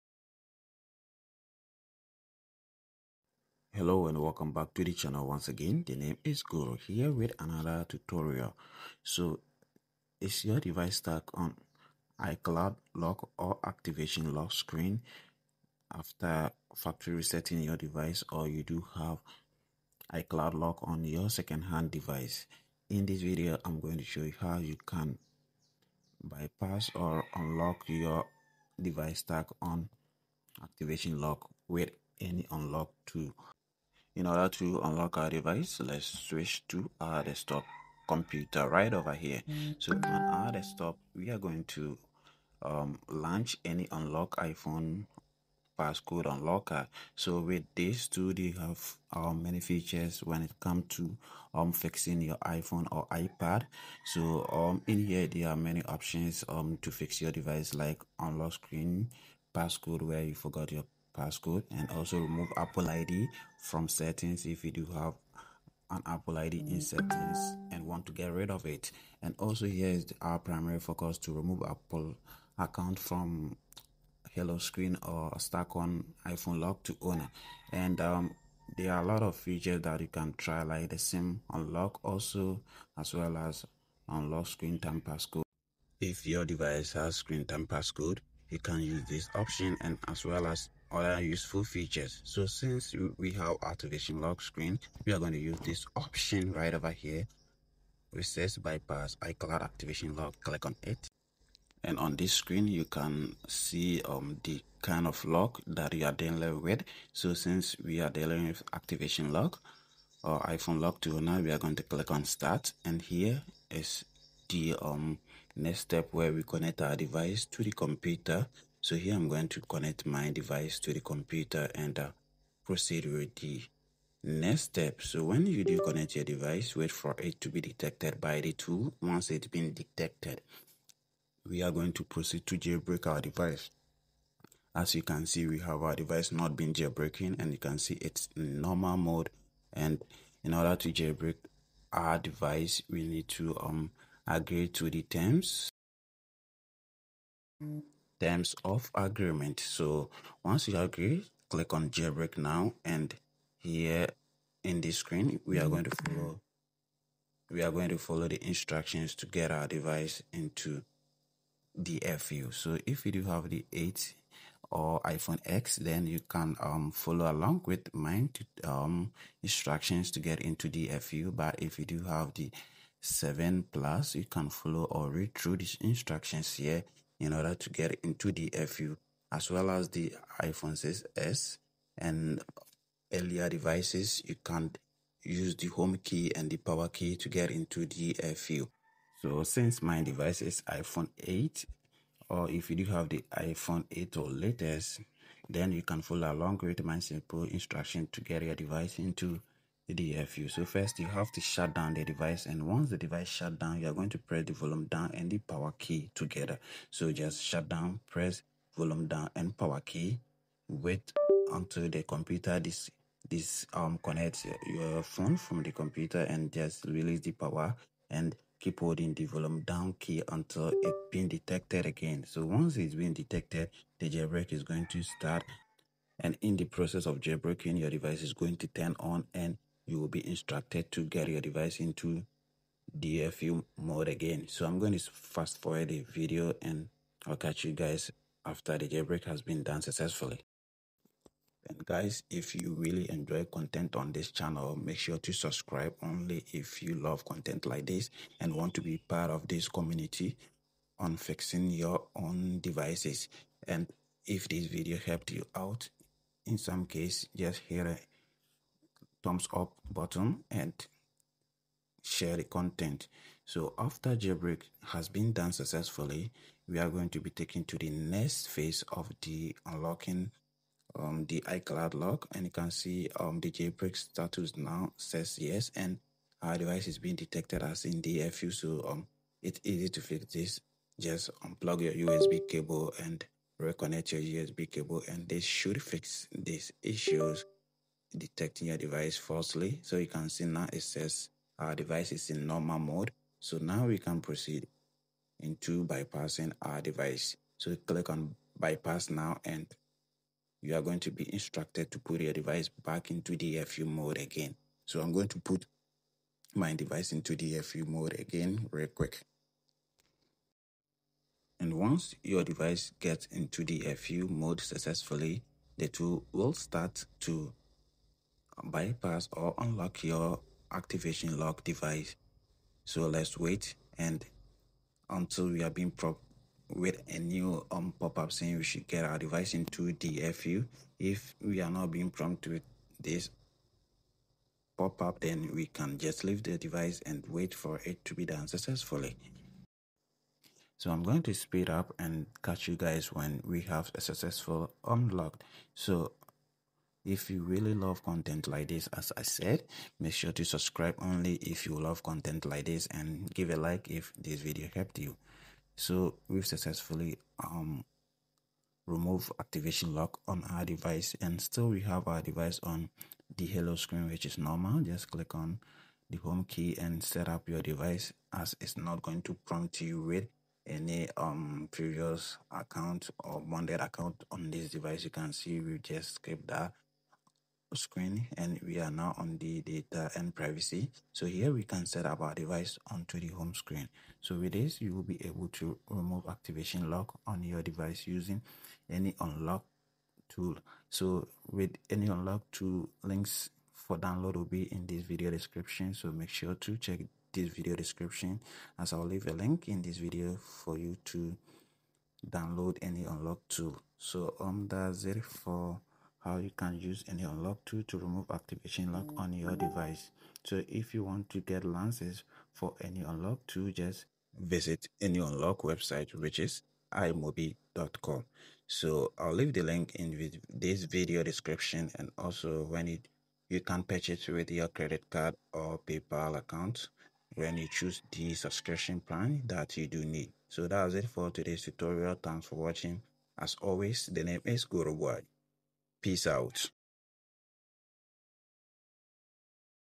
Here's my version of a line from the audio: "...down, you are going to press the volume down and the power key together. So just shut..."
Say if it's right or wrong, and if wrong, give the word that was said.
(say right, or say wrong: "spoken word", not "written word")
right.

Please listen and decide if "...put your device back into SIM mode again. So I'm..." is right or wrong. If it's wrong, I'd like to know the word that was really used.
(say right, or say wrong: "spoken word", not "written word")
wrong: "DFU", not "SIM".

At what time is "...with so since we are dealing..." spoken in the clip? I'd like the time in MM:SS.
01:46.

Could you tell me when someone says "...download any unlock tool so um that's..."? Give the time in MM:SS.
06:42.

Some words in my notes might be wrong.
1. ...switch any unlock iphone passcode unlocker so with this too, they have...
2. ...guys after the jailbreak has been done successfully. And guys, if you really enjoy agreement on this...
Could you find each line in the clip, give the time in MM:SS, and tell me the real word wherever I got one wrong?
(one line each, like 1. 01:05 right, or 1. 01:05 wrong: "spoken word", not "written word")
1. 00:43 wrong: "launch", not "switch"
2. 03:57 wrong: "content", not "agreement".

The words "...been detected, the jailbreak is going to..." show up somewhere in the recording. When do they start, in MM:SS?
03:42.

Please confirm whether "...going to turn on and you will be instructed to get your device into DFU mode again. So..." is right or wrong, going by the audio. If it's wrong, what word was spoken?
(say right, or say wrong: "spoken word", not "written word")
right.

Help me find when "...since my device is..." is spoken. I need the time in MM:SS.
03:09.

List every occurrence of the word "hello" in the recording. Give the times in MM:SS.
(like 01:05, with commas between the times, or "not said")
00:03, 01:14, 06:03.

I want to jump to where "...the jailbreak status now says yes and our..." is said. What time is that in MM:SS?
04:33.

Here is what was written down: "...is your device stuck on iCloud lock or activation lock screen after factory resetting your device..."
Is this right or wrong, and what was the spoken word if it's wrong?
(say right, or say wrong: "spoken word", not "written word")
right.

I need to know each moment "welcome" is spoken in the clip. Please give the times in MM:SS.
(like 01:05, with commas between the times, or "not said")
00:04.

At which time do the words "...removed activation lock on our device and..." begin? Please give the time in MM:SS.
05:58.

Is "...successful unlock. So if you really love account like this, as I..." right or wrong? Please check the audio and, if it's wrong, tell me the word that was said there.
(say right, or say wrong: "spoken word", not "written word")
wrong: "content", not "account".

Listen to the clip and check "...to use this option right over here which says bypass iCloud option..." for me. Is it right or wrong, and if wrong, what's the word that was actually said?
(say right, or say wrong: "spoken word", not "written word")
wrong: "activation", not "option".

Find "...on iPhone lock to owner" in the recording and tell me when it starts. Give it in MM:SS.
01:15.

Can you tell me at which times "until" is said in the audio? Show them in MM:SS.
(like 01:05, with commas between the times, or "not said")
03:31, 03:40, 05:25.